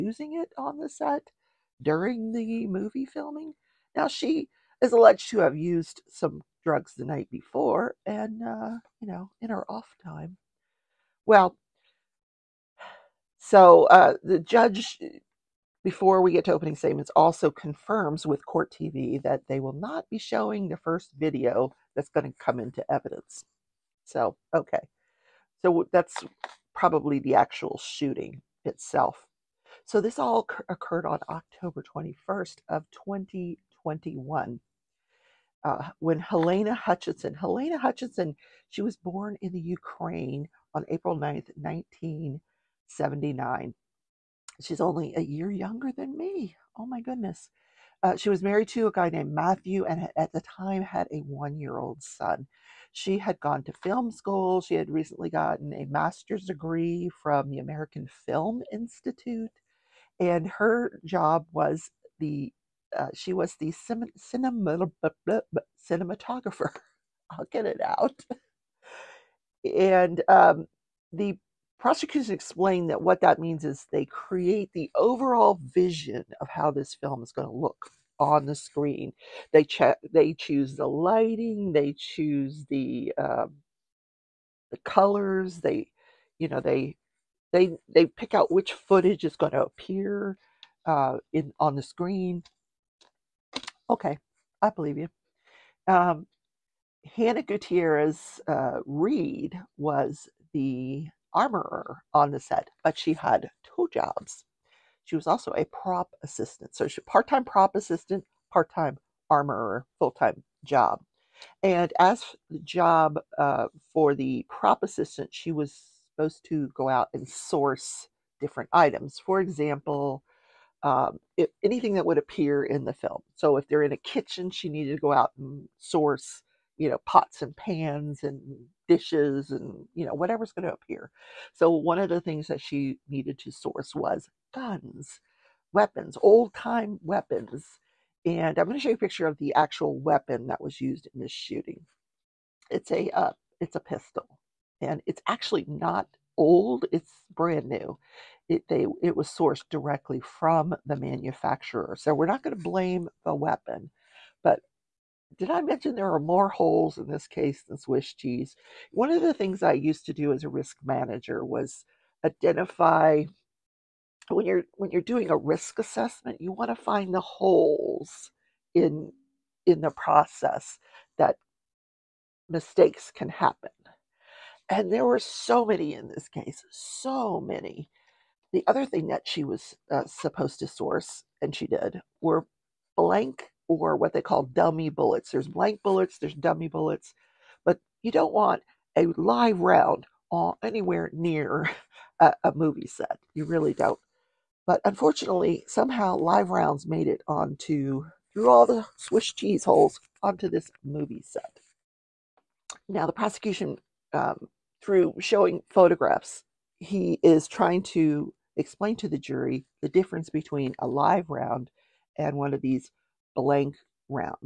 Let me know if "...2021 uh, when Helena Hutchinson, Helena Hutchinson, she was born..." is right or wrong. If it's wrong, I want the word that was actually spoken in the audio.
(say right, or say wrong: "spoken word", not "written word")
right.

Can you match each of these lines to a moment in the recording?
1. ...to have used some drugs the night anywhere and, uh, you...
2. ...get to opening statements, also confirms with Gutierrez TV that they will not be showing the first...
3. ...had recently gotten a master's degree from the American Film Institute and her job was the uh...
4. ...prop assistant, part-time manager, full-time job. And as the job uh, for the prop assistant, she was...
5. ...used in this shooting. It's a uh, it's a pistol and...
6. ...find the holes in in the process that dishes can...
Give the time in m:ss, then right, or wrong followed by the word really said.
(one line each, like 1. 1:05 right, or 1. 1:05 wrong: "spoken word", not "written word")
1. 0:05 wrong: "before", not "anywhere"
2. 0:16 wrong: "Court", not "Gutierrez"
3. 0:54 right
4. 1:47 wrong: "armorer", not "manager"
5. 2:20 right
6. 2:46 wrong: "mistakes", not "dishes".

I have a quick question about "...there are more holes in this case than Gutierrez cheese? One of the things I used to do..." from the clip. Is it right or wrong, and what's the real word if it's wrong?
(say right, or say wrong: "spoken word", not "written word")
wrong: "Swiss", not "Gutierrez".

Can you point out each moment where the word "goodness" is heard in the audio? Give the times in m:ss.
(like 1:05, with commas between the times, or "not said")
0:46.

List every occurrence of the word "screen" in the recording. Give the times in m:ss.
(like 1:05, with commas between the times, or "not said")
1:18, 1:31.